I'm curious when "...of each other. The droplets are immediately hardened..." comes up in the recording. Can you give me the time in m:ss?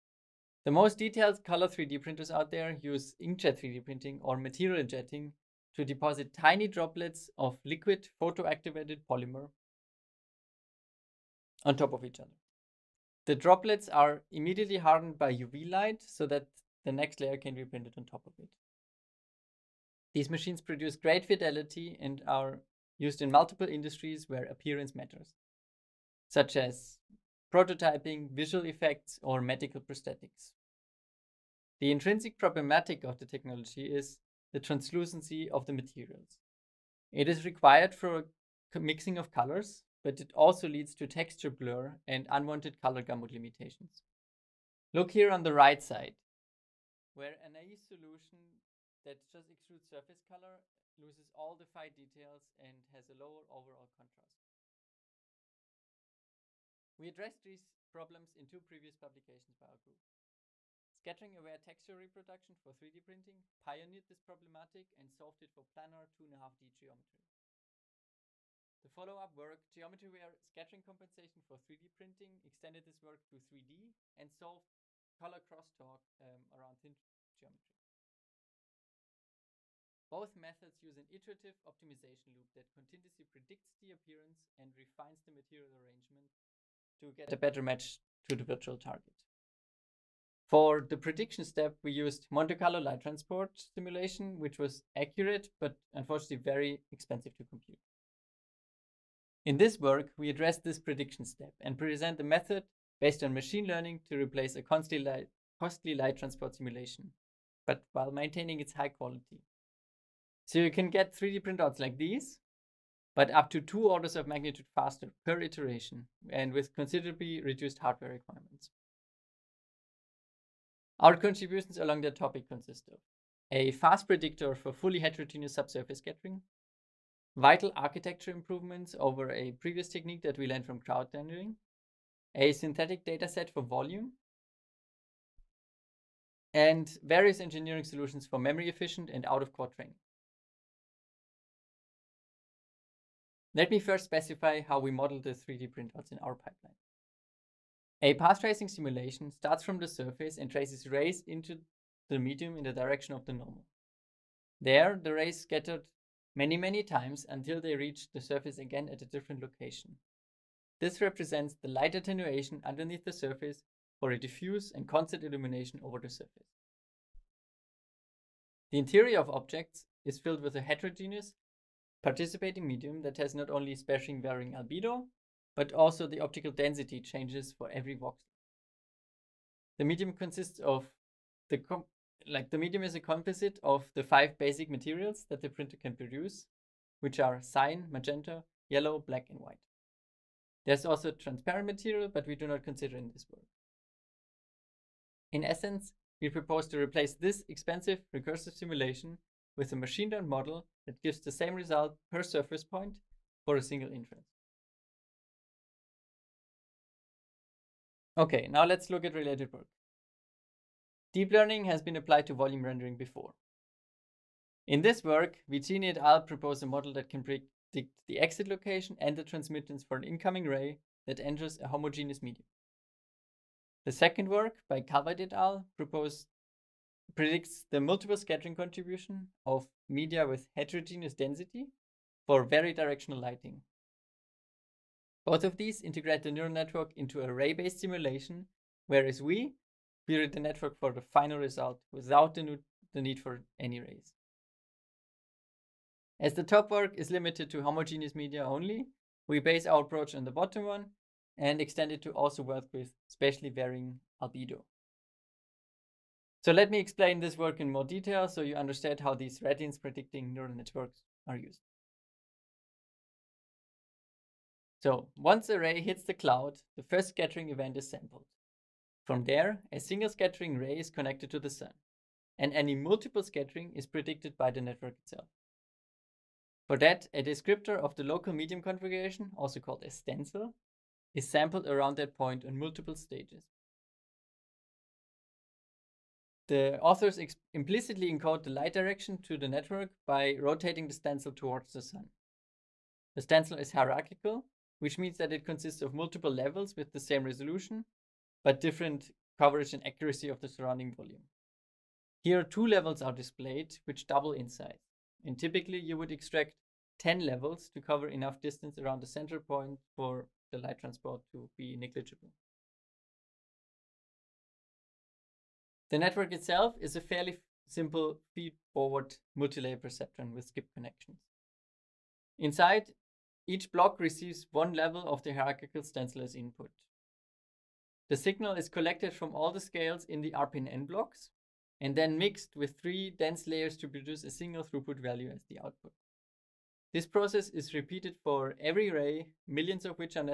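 0:11.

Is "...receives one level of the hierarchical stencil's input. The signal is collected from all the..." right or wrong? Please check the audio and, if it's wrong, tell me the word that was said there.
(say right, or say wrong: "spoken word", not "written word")
right.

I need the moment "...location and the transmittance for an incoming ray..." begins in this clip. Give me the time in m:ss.
3:38.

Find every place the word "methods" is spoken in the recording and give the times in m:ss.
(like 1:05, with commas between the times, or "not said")
1:20, 1:42.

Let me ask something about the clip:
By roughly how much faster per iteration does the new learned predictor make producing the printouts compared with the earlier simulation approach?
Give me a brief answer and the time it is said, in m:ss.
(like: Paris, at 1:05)
2 orders of magnitude, at 1:53.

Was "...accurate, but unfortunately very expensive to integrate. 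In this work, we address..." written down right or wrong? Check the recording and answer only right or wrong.
wrong.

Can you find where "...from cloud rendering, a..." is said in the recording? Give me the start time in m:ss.
2:10.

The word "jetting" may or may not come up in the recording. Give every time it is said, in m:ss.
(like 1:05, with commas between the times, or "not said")
0:04.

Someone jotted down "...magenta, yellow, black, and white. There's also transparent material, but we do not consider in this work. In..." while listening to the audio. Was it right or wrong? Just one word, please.
right.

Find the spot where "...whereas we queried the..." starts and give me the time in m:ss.
3:58.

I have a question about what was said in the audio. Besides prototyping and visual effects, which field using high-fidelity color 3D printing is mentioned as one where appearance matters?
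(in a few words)
medical prosthetics.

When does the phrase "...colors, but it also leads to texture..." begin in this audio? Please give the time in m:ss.
0:39.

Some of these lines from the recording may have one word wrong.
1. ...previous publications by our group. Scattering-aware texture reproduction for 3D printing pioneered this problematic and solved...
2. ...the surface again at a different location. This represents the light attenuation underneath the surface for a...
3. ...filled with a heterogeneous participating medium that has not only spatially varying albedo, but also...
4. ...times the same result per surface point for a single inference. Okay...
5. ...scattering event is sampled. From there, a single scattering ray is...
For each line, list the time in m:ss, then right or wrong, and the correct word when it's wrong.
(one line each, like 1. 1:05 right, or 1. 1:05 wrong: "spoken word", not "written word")
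1. 0:58 right
2. 2:38 right
3. 2:50 right
4. 3:21 wrong: "gives", not "times"
5. 4:27 right.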